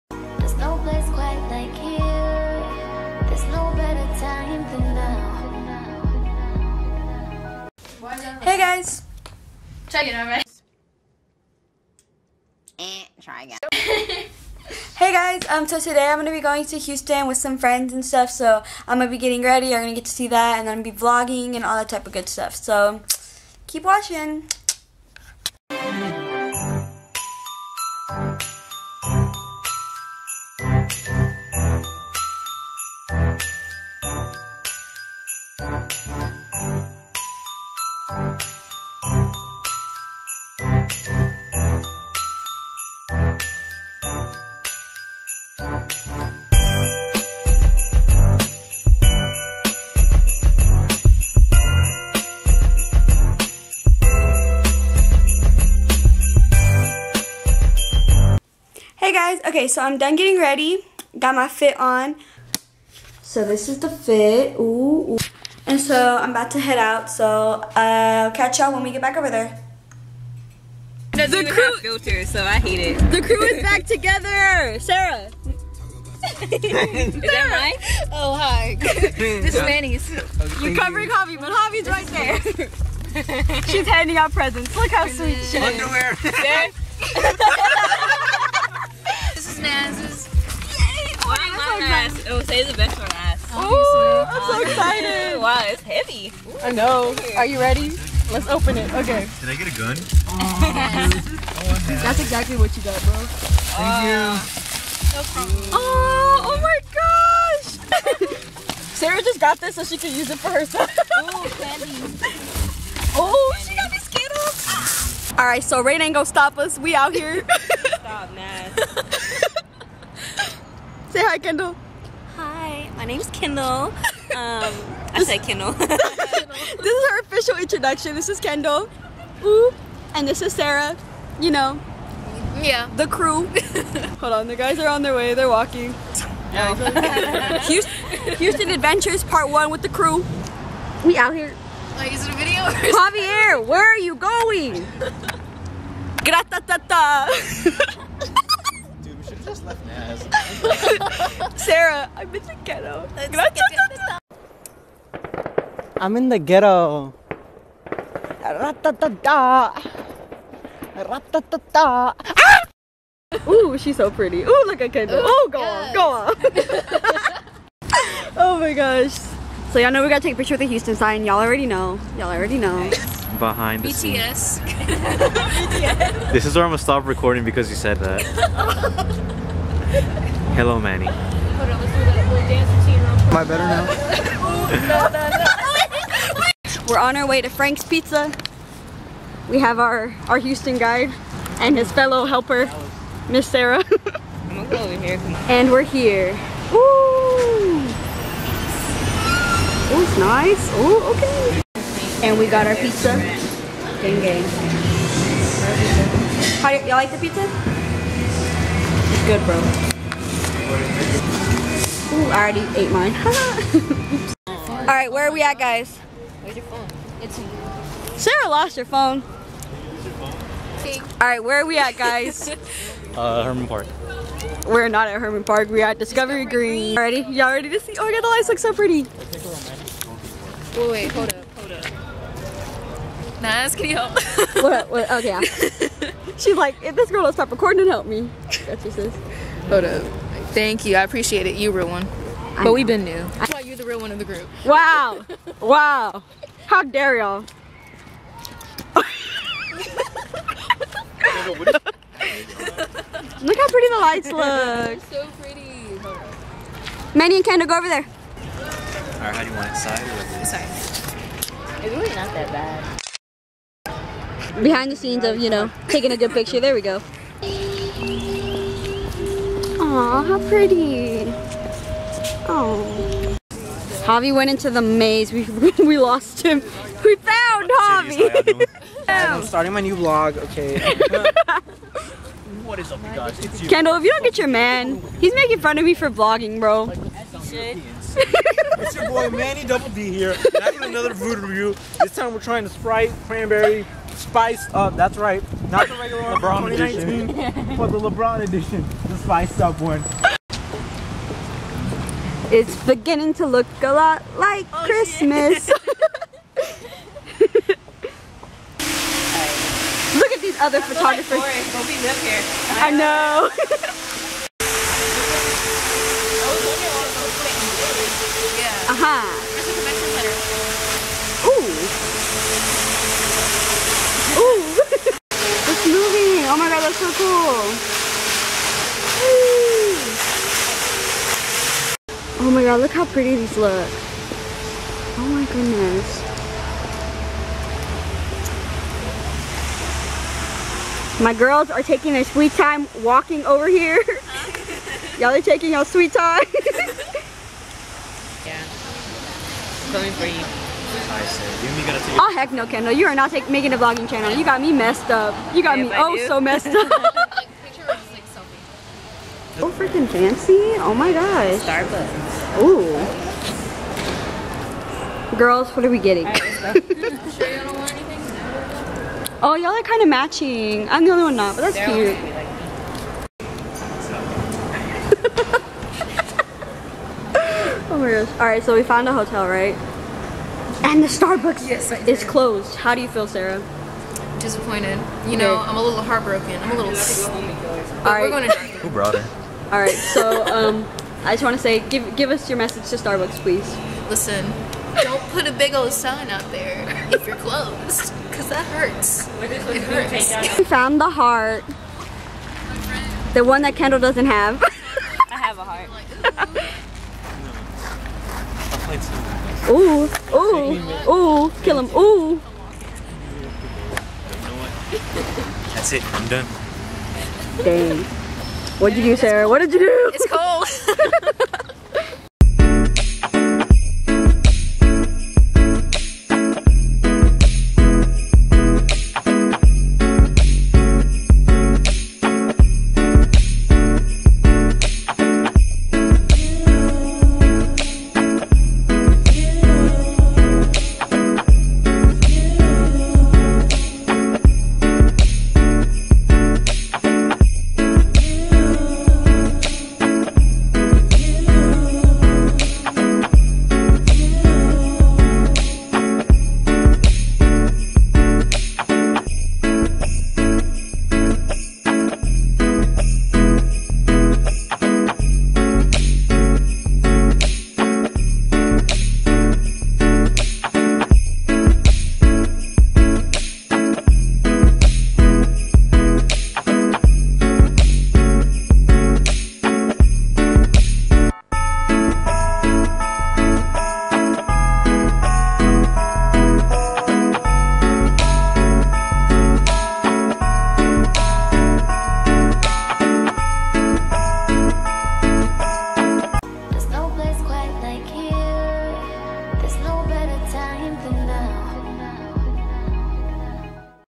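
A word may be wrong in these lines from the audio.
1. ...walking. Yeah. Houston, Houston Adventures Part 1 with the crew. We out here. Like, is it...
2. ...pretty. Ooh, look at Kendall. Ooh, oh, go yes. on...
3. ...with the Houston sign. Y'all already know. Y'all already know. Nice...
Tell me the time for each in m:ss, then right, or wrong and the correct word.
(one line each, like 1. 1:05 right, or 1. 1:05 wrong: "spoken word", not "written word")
1. 2:15 right
2. 2:44 right
3. 2:50 right.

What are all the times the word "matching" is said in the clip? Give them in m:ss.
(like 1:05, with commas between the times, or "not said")
6:10.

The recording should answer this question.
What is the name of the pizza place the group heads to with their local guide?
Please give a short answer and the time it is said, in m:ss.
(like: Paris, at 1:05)
Frank's Pizza, at 3:07.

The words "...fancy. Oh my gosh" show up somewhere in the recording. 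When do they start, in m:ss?
6:00.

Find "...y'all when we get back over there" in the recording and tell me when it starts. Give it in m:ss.
1:08.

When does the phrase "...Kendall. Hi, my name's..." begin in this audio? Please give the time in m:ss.
2:01.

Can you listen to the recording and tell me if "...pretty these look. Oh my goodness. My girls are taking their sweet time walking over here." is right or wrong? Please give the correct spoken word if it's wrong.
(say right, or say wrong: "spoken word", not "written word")
right.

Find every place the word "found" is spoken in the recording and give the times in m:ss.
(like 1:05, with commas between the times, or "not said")
4:37, 6:18, 6:40.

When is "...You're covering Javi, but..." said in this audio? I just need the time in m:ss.
1:20.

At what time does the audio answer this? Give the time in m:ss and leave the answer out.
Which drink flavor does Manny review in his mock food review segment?
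4:52.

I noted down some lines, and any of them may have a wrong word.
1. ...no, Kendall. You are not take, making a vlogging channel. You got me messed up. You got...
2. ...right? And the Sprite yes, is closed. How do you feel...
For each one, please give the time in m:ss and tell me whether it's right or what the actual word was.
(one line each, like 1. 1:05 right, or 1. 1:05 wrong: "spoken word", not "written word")
1. 5:52 right
2. 6:19 wrong: "Starbucks", not "Sprite".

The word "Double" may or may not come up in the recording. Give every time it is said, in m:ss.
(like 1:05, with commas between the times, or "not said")
4:49.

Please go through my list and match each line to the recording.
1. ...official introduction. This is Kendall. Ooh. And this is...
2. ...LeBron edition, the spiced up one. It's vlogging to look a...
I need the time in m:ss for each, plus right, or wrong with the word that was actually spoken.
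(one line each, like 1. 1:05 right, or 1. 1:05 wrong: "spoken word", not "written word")
1. 2:07 right
2. 4:57 wrong: "beginning", not "vlogging".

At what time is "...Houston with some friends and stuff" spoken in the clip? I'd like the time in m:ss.
0:16.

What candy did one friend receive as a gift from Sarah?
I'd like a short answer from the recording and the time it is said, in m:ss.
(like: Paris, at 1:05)
Skittles, at 1:53.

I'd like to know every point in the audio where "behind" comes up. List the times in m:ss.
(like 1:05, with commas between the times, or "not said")
2:53, 4:24.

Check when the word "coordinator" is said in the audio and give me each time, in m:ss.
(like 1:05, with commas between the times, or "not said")
not said.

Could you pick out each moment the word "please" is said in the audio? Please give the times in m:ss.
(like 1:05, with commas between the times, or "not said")
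6:33.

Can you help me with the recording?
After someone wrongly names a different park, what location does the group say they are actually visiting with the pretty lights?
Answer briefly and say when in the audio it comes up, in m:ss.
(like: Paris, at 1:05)
Discovery Green, at 3:46.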